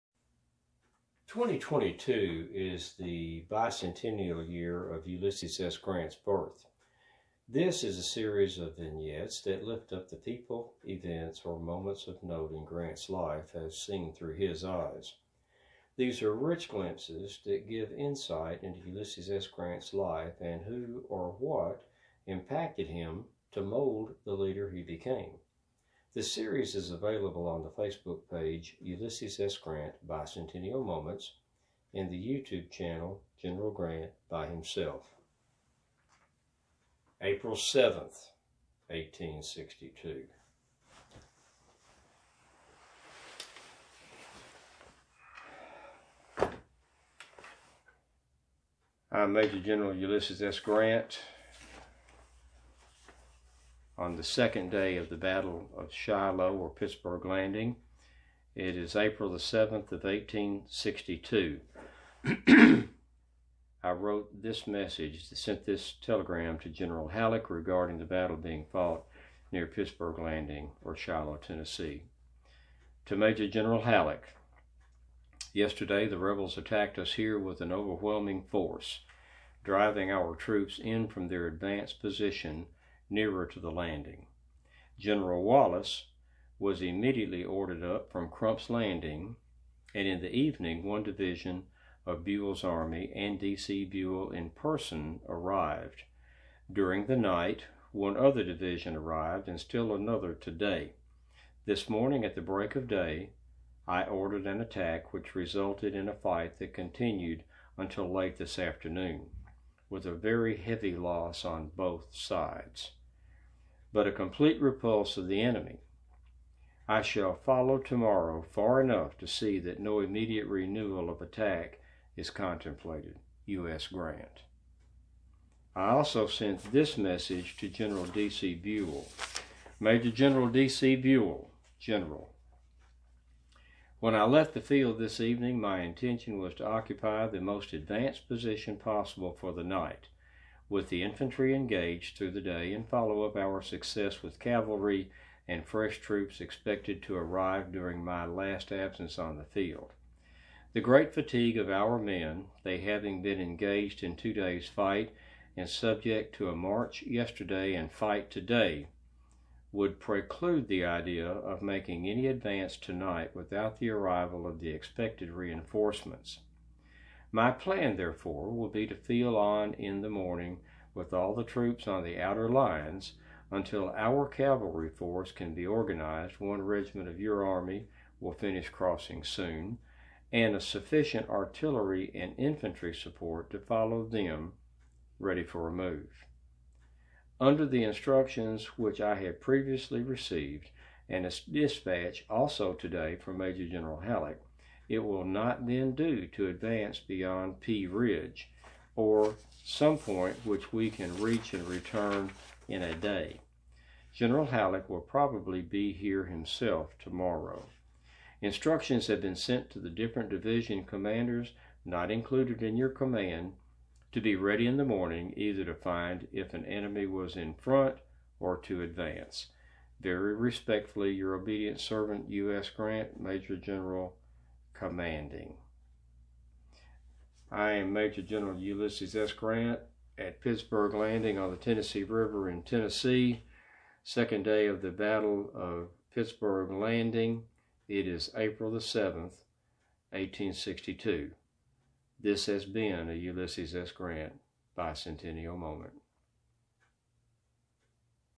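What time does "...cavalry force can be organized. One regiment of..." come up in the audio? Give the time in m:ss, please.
2:54.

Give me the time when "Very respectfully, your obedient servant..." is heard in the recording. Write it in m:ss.
3:40.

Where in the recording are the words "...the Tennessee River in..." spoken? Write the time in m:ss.
3:51.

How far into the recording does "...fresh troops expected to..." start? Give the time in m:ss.
2:25.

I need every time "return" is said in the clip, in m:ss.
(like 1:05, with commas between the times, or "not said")
3:21.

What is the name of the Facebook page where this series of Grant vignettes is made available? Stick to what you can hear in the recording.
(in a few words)
Ulysses S. Grant Bicentennial Moments.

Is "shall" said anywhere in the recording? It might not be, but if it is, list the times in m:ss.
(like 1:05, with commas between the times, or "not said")
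1:57.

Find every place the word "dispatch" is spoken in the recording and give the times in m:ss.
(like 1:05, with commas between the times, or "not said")
3:11.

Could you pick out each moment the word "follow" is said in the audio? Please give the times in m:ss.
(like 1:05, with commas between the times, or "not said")
1:57, 2:22, 3:03.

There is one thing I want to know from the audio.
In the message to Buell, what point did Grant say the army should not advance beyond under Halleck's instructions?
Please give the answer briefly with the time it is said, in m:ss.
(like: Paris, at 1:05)
Pea Ridge, at 3:17.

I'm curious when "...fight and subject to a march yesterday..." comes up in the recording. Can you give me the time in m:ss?
2:34.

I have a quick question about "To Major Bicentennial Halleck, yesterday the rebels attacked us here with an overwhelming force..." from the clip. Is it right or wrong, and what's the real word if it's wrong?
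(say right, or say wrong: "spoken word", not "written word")
wrong: "General", not "Bicentennial".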